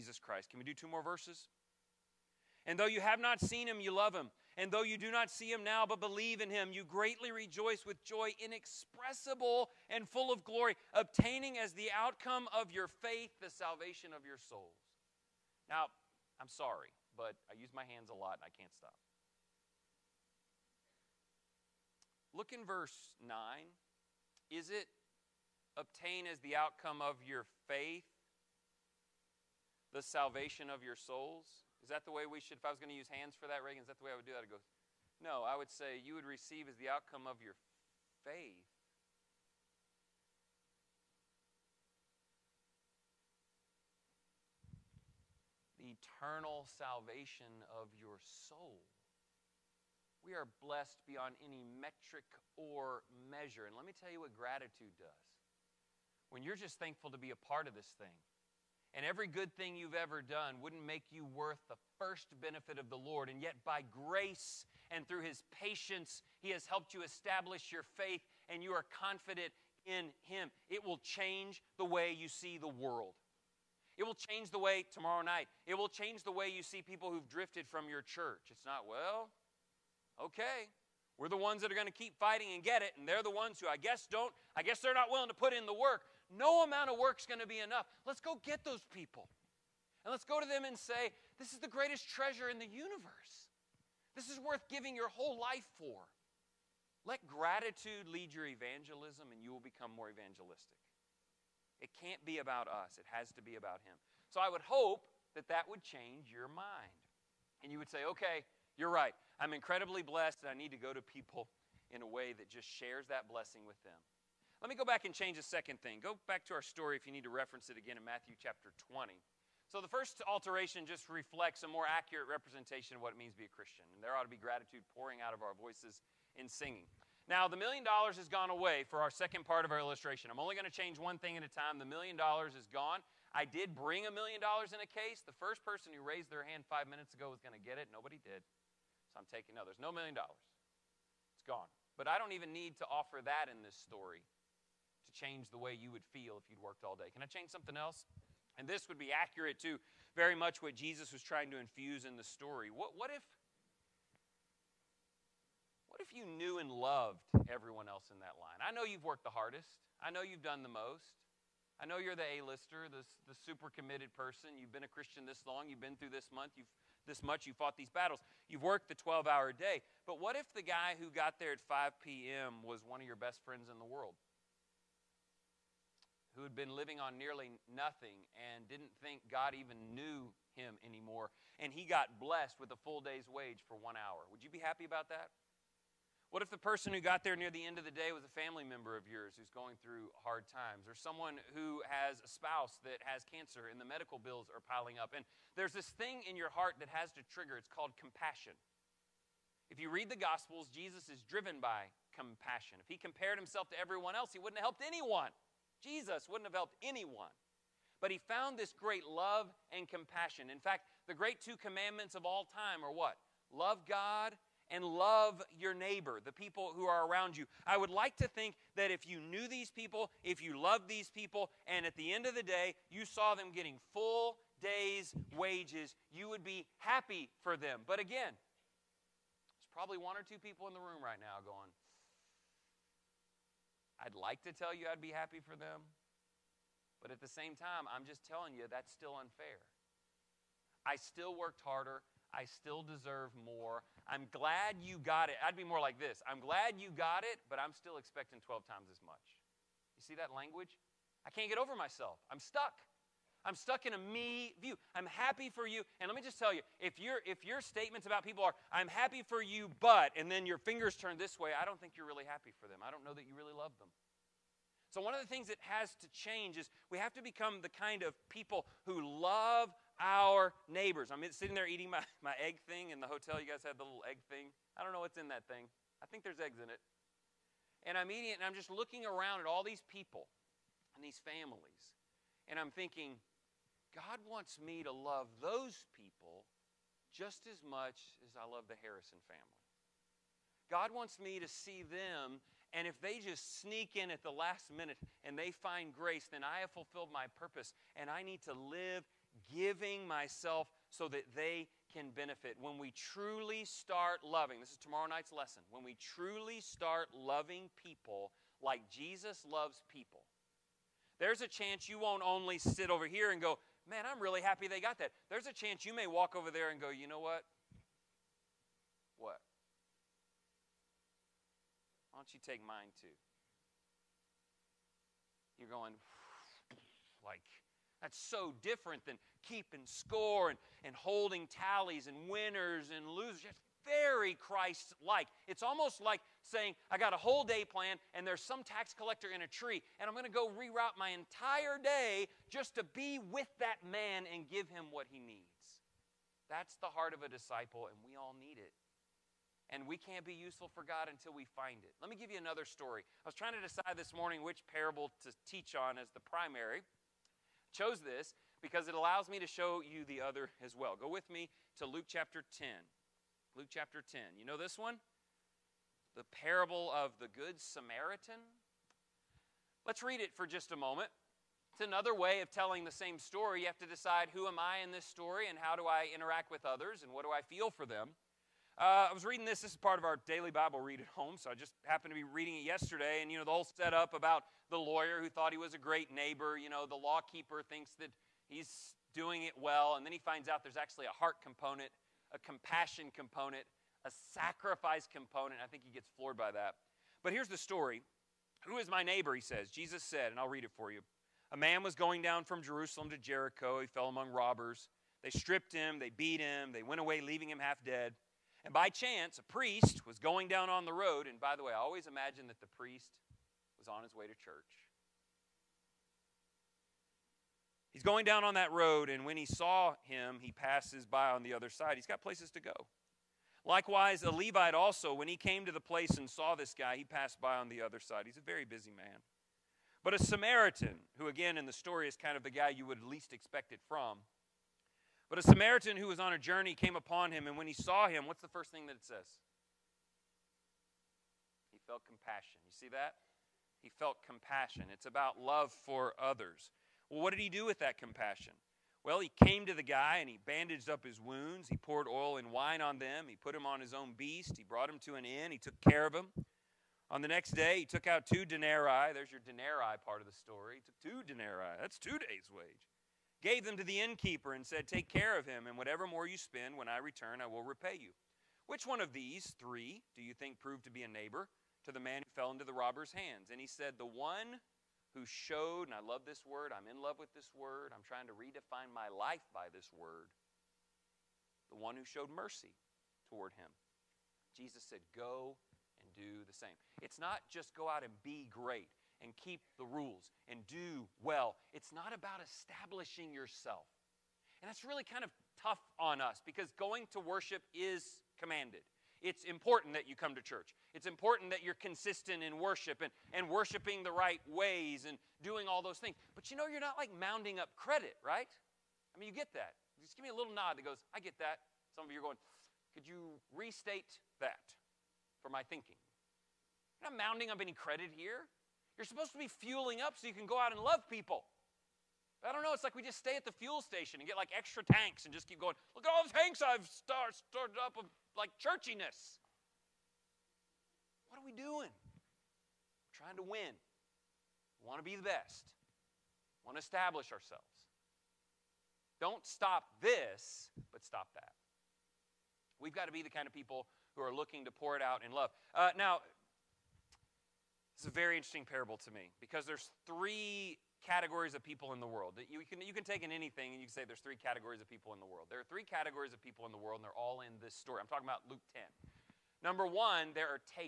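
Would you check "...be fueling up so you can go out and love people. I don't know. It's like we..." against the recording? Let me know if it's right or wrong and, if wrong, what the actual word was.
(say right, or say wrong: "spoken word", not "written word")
right.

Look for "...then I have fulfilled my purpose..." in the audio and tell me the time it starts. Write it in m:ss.
4:56.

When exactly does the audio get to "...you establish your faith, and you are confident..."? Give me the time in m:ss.
1:06.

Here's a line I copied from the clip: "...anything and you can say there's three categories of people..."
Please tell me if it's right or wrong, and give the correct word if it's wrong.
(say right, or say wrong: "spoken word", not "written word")
right.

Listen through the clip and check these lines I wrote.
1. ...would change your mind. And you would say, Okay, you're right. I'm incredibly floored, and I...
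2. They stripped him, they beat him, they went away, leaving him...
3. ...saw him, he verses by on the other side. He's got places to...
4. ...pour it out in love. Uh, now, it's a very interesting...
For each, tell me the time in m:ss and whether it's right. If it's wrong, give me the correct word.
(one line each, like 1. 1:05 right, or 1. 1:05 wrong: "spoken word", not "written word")
1. 1:45 wrong: "blessed", not "floored"
2. 6:45 right
3. 6:59 wrong: "passes", not "verses"
4. 9:04 right.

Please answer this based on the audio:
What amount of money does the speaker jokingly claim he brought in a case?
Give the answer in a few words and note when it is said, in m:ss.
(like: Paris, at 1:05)
1 million dollars, at 2:14.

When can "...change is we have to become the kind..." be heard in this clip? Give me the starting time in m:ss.
4:26.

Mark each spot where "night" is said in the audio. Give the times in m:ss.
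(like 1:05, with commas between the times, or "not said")
1:15, 5:05.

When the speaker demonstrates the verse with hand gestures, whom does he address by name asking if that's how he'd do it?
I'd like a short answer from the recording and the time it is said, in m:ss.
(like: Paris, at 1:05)
Reagan, at 0:33.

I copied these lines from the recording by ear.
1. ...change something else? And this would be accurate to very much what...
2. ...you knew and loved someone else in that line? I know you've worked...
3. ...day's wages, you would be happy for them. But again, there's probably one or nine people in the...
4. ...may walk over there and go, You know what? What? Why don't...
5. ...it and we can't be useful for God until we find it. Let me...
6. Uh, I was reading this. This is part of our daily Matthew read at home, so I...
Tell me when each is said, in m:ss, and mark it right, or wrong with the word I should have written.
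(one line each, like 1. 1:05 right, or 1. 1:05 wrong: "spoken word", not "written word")
1. 2:27 right
2. 2:36 wrong: "everyone", not "someone"
3. 3:44 wrong: "two", not "nine"
4. 5:15 right
5. 5:48 right
6. 6:18 wrong: "Bible", not "Matthew".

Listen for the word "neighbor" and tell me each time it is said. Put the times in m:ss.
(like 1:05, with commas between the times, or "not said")
3:35, 4:30, 6:26, 6:39, 7:51.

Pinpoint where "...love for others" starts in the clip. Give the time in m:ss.
7:25.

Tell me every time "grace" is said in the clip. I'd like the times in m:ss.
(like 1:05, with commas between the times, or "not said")
1:03, 4:55.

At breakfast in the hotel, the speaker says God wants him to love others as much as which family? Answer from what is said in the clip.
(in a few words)
The Harrison family.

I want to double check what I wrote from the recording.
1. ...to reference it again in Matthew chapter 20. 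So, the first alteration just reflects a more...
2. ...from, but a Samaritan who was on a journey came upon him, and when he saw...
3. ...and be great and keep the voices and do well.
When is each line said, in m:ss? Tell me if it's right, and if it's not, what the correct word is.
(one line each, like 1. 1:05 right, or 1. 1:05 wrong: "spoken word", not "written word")
1. 1:57 right
2. 7:13 right
3. 8:08 wrong: "rules", not "voices".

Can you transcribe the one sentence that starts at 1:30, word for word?
And let's go to them and say, This is the greatest treasure in the universe.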